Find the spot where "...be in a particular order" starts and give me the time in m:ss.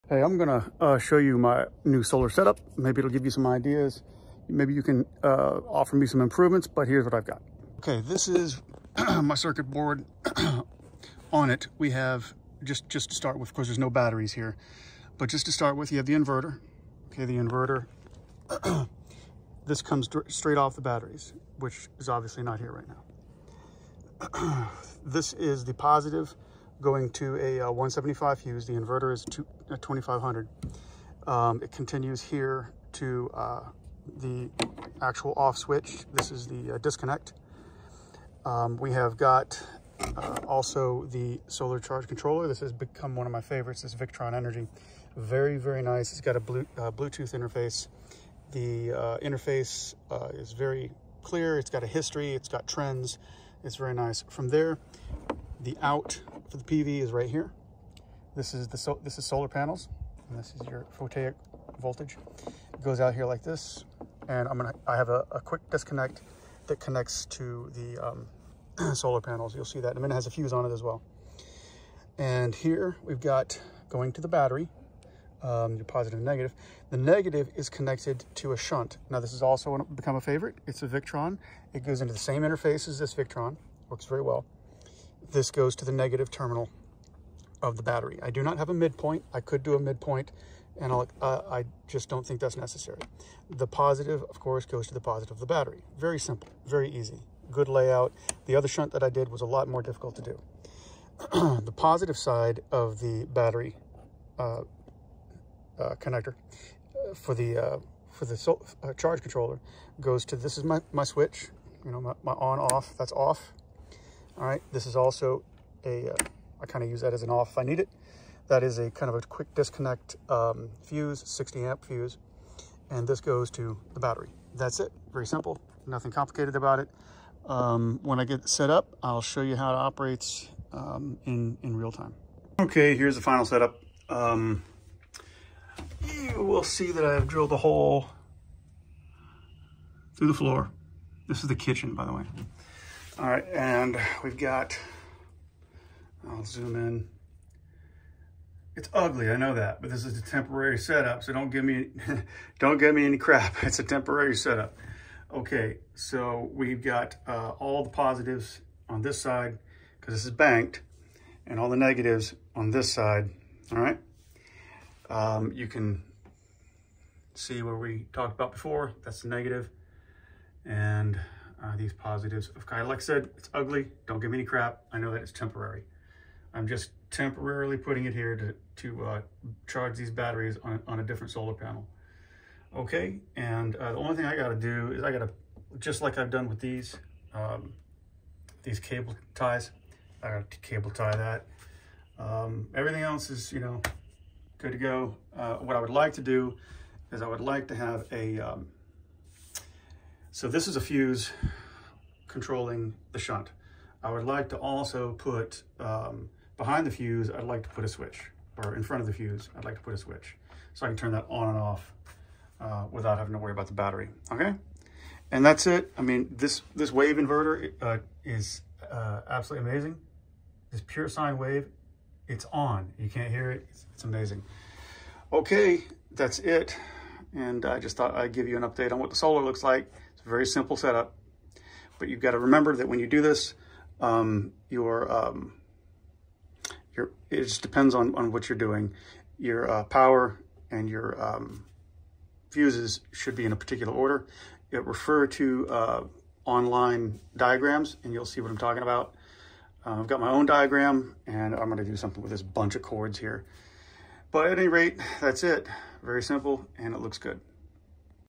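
4:03.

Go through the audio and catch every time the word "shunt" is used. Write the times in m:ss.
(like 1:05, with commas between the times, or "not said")
1:18, 1:38, 3:23.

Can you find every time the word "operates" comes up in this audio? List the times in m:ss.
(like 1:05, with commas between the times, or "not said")
2:09.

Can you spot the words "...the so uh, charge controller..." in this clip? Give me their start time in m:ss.
1:48.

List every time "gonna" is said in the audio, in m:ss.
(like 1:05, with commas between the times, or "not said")
0:00, 1:04, 4:11.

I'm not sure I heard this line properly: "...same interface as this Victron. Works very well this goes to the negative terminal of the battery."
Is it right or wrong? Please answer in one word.
right.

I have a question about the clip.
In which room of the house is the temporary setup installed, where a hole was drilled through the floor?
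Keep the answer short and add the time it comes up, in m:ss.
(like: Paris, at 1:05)
The kitchen, at 2:21.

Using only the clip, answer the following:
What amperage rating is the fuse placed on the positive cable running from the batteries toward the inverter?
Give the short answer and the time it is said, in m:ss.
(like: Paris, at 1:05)
175, at 0:27.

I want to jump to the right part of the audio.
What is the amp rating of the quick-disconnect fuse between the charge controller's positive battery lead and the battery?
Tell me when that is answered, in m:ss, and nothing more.
2:01.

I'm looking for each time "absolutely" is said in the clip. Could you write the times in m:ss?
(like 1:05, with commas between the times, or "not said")
3:39.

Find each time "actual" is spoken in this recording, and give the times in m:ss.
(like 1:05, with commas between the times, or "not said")
0:35.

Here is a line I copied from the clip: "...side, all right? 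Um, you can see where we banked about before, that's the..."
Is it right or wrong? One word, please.
wrong.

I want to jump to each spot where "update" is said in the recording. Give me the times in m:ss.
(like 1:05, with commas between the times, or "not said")
3:48.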